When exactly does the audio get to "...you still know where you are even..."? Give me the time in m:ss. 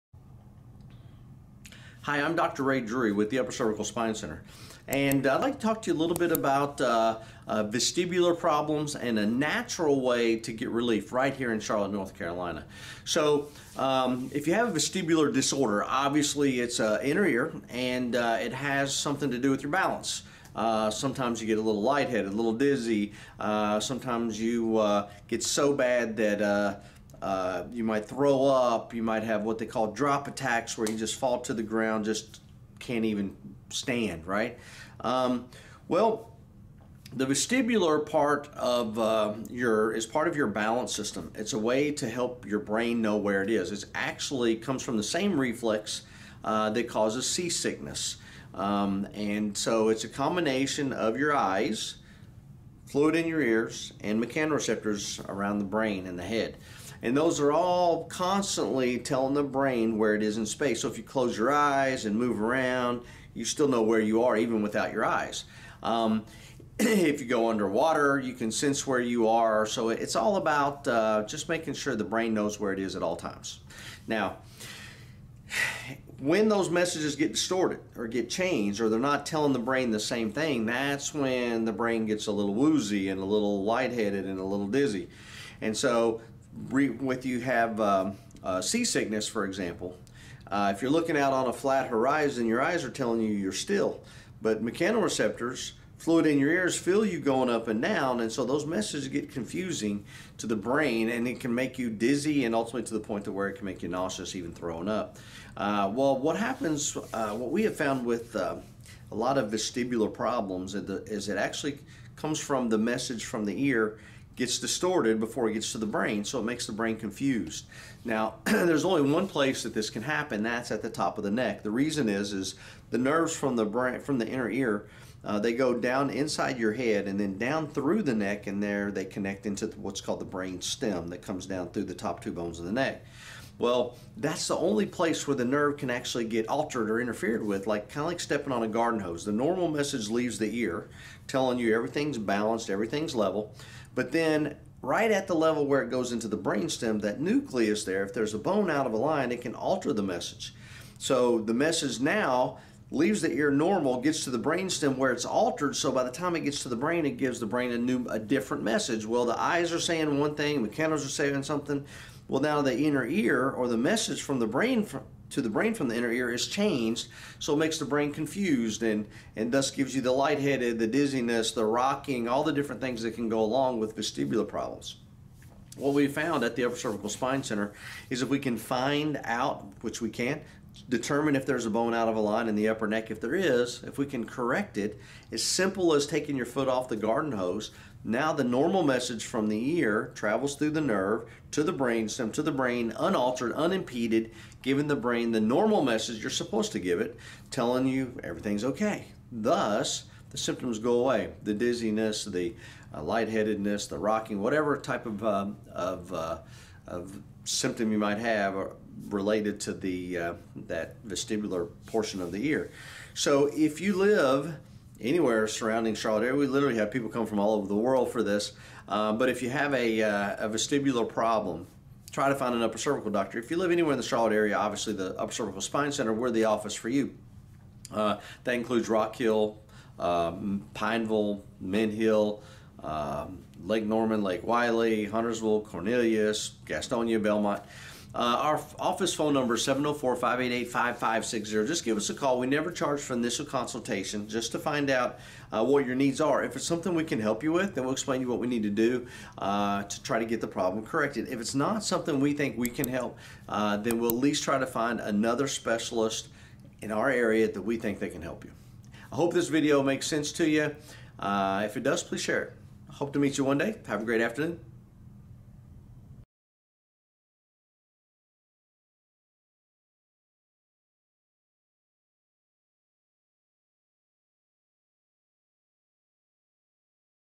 1:03.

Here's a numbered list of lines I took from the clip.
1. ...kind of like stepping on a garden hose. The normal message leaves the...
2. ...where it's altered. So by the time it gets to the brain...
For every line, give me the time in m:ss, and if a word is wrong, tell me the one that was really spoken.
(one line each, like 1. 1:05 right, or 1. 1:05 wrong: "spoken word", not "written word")
1. 2:17 right
2. 2:34 right.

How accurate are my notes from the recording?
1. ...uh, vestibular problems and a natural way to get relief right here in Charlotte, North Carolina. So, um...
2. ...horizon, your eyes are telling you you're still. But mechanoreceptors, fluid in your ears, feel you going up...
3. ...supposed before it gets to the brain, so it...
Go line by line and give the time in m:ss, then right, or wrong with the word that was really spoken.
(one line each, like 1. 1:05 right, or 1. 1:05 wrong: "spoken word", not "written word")
1. 0:07 right
2. 1:31 right
3. 1:54 wrong: "distorted", not "supposed".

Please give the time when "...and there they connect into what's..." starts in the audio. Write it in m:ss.
2:08.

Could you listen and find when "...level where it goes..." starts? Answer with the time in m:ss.
2:25.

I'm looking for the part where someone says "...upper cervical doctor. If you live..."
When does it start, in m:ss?
3:42.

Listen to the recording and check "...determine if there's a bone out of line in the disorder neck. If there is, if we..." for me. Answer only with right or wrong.
wrong.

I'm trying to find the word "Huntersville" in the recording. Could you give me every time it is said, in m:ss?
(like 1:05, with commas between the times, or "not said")
3:55.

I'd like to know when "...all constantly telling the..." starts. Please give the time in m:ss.
0:57.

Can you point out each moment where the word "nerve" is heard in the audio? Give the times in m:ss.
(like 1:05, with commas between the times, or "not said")
2:02, 2:15, 3:10.